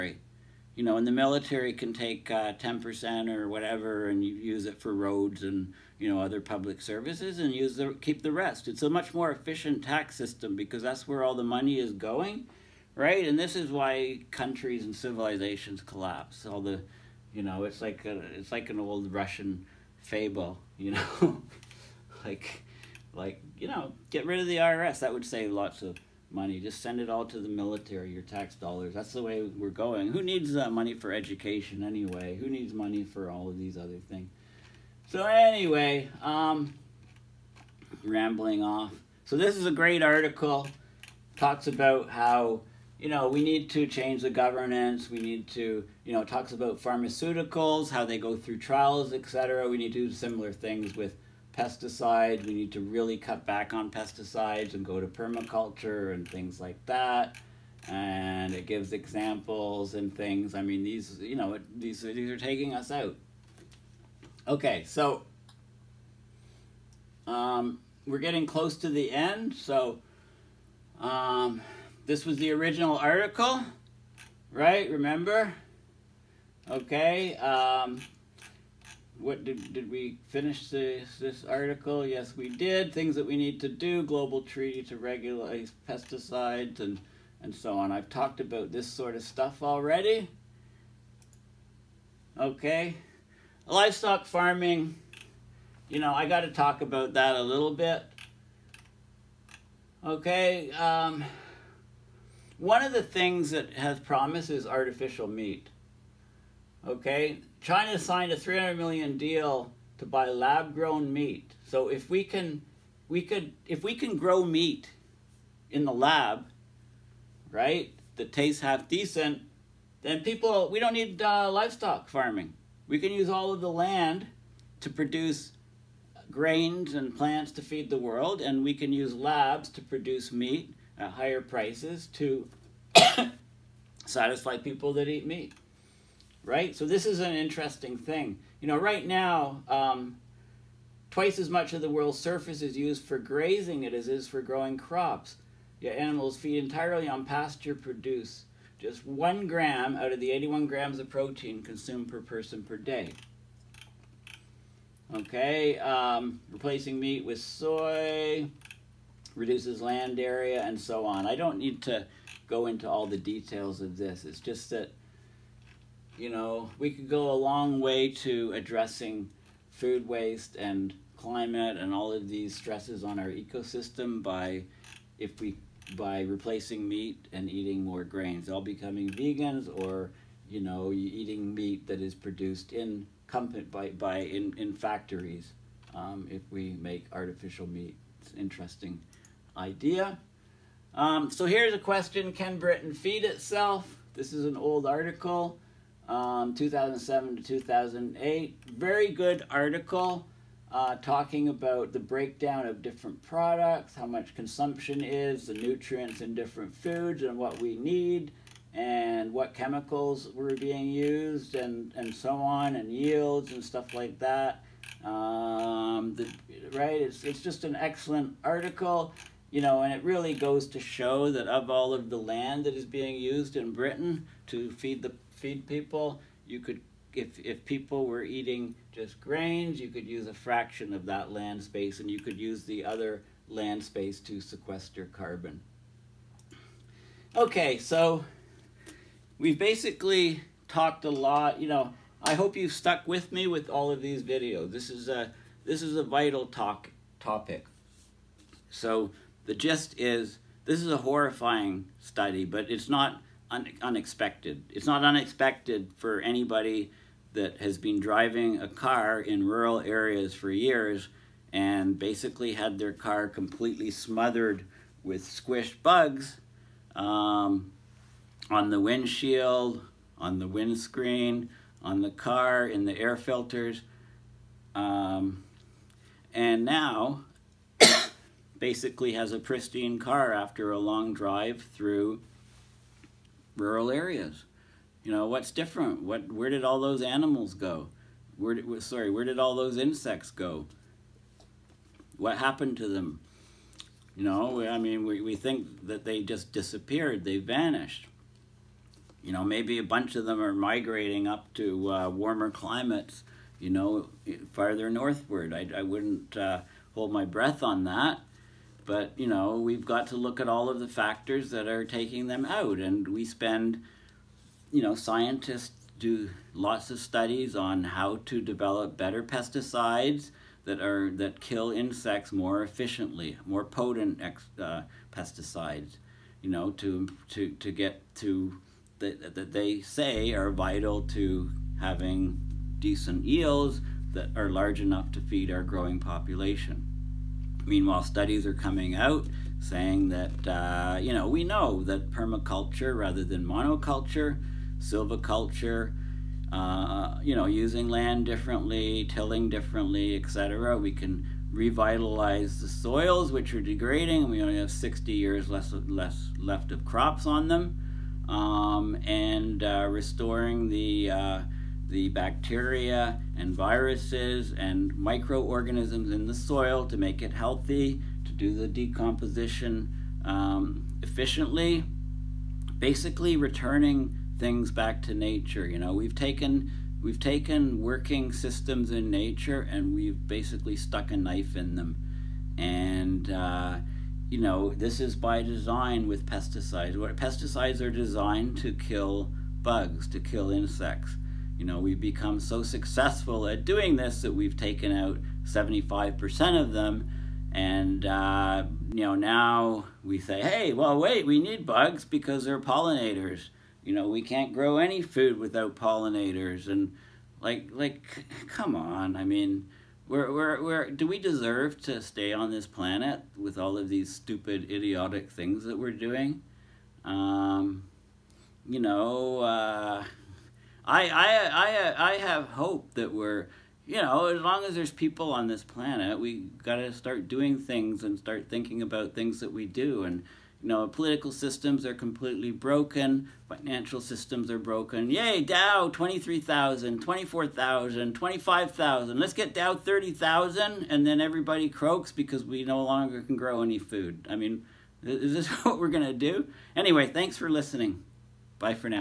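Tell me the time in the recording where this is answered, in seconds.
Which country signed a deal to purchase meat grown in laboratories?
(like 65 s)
107 s.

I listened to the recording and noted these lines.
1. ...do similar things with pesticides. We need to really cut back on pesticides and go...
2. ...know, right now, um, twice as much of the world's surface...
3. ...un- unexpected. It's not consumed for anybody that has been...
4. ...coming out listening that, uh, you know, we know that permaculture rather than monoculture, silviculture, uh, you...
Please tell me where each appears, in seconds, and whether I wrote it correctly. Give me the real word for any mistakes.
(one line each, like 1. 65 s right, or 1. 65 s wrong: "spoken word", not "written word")
1. 50 s right
2. 138 s right
3. 253 s wrong: "unexpected", not "consumed"
4. 338 s wrong: "saying", not "listening".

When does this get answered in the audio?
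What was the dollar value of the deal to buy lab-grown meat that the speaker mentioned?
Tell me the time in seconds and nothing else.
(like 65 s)
108 s.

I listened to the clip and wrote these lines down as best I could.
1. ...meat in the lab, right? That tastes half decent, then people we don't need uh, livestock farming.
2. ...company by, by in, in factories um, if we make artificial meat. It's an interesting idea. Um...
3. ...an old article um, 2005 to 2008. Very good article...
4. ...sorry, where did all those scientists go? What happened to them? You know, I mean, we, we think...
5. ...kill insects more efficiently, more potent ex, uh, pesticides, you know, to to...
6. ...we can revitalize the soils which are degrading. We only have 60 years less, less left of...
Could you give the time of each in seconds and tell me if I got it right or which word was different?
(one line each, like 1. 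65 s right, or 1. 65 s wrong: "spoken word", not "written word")
1. 114 s right
2. 183 s right
3. 194 s wrong: "2007", not "2005"
4. 288 s wrong: "insects", not "scientists"
5. 321 s right
6. 350 s right.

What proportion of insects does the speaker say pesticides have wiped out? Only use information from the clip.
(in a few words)
75%.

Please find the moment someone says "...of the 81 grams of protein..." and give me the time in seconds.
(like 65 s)
150 s.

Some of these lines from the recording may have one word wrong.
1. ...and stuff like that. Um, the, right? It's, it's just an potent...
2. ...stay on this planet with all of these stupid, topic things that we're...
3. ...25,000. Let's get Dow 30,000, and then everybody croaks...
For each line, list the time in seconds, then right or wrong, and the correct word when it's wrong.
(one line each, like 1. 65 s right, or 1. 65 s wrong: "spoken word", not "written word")
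1. 213 s wrong: "excellent", not "potent"
2. 412 s wrong: "idiotic", not "topic"
3. 438 s right.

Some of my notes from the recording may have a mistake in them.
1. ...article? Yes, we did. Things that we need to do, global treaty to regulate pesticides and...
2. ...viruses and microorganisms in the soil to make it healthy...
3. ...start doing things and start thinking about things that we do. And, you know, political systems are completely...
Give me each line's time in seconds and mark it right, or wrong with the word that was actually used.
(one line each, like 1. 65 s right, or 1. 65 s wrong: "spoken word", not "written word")
1. 81 s right
2. 363 s right
3. 426 s right.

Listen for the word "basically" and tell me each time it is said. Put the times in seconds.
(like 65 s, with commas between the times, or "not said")
239 s, 261 s, 278 s, 372 s, 380 s.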